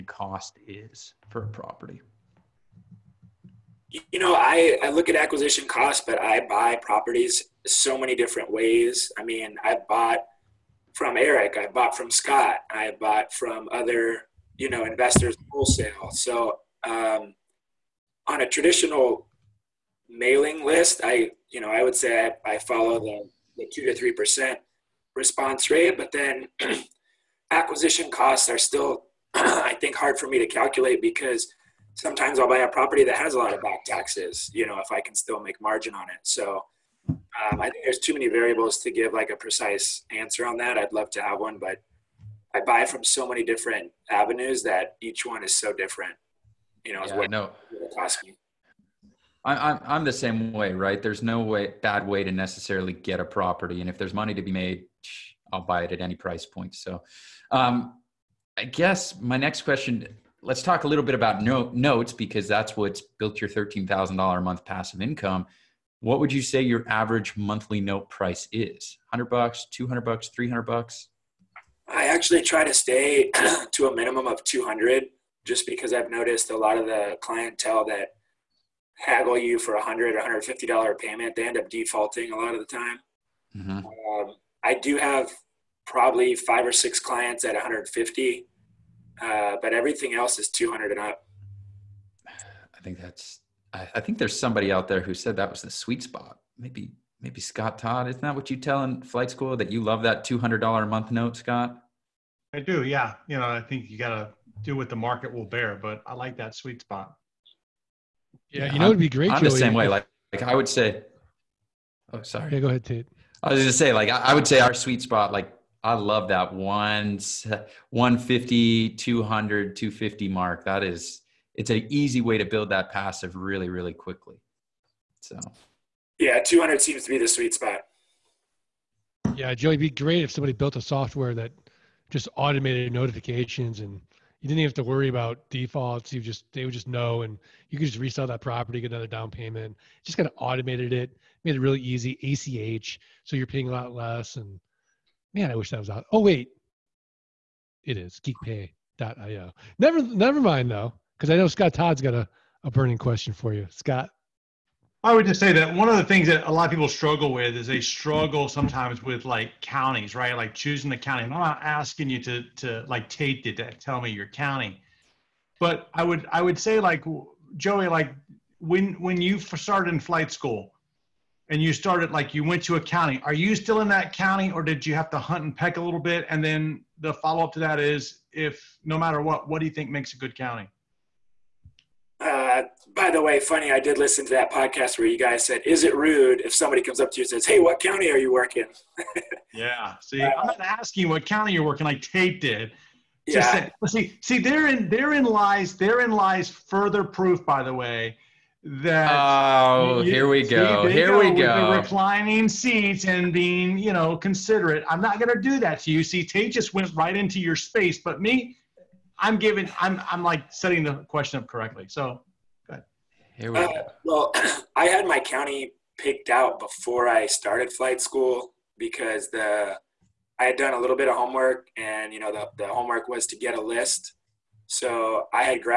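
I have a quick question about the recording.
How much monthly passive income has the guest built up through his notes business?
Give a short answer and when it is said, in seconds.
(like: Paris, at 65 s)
$13,000, at 63 s.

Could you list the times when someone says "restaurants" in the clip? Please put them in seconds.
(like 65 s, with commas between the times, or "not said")
not said.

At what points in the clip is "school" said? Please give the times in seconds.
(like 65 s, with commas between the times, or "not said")
99 s, 170 s, 218 s.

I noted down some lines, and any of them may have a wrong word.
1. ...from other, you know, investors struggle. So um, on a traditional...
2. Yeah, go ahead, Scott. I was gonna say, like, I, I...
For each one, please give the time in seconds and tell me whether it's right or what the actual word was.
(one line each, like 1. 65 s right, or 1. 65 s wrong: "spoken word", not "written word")
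1. 13 s wrong: "wholesale", not "struggle"
2. 112 s wrong: "Tate", not "Scott".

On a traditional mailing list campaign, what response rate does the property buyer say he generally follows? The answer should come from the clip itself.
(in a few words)
2 to 3 percent.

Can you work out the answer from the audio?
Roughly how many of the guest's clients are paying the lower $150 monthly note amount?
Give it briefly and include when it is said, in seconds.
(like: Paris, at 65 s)
5 or 6, at 86 s.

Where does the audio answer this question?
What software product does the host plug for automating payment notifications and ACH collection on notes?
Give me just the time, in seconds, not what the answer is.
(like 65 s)
148 s.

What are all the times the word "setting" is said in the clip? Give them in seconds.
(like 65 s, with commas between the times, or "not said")
210 s.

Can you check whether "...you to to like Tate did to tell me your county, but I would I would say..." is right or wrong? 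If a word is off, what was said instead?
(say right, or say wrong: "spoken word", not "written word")
right.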